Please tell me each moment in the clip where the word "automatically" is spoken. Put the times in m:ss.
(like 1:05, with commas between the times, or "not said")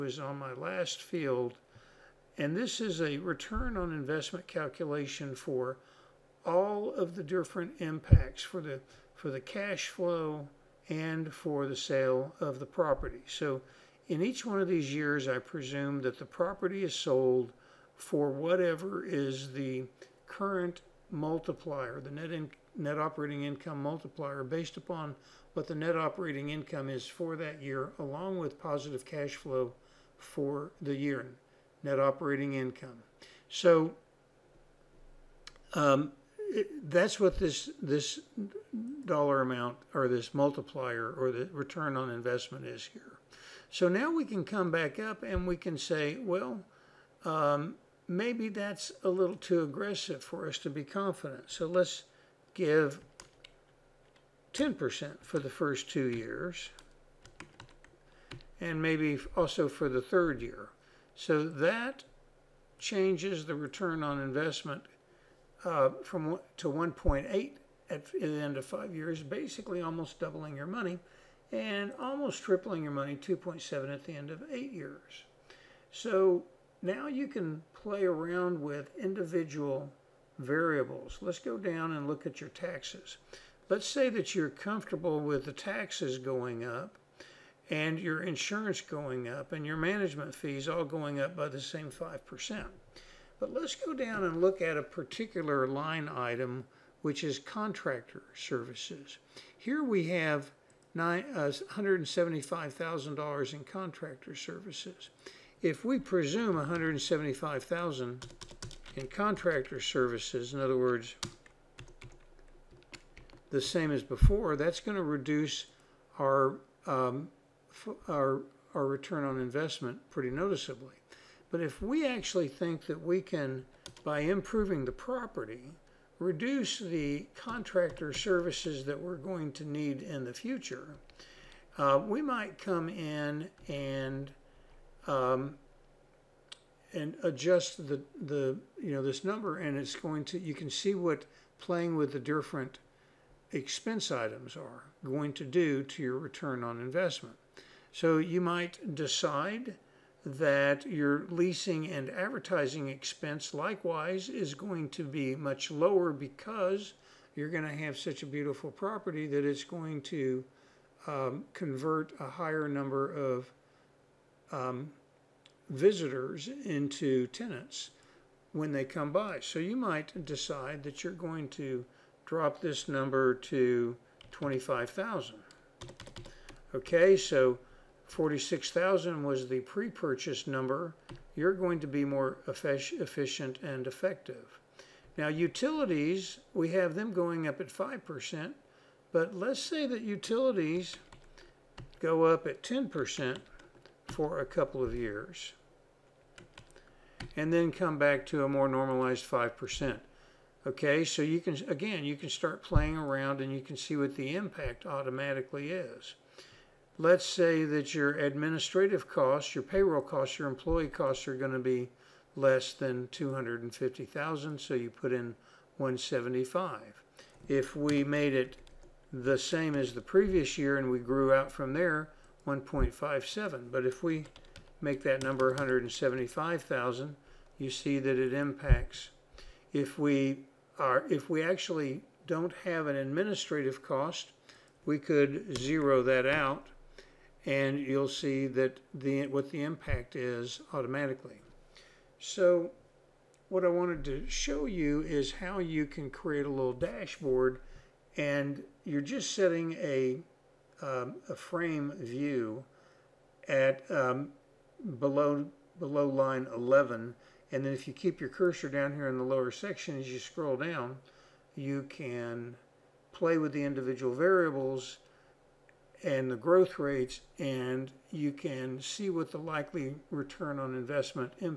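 3:24, 4:00.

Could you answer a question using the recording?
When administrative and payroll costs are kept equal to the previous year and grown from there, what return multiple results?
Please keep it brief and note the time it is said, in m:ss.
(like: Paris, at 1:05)
1.57, at 3:42.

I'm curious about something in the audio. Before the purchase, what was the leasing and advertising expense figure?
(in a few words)
46,000.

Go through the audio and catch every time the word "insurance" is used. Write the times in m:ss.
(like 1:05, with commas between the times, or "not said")
1:28.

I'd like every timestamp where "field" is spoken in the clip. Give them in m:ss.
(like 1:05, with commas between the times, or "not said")
0:01.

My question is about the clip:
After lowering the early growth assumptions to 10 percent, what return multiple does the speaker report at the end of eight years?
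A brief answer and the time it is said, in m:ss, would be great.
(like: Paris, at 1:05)
2.7, at 1:13.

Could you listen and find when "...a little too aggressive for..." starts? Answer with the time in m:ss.
0:49.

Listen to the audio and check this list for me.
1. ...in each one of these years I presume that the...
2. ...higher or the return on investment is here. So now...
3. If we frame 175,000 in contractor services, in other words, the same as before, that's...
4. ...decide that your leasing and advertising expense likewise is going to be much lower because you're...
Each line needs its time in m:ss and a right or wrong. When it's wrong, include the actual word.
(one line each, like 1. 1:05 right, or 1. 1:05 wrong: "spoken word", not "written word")
1. 0:14 right
2. 0:40 wrong: "multiplier", not "higher"
3. 1:45 wrong: "presume", not "frame"
4. 2:28 right.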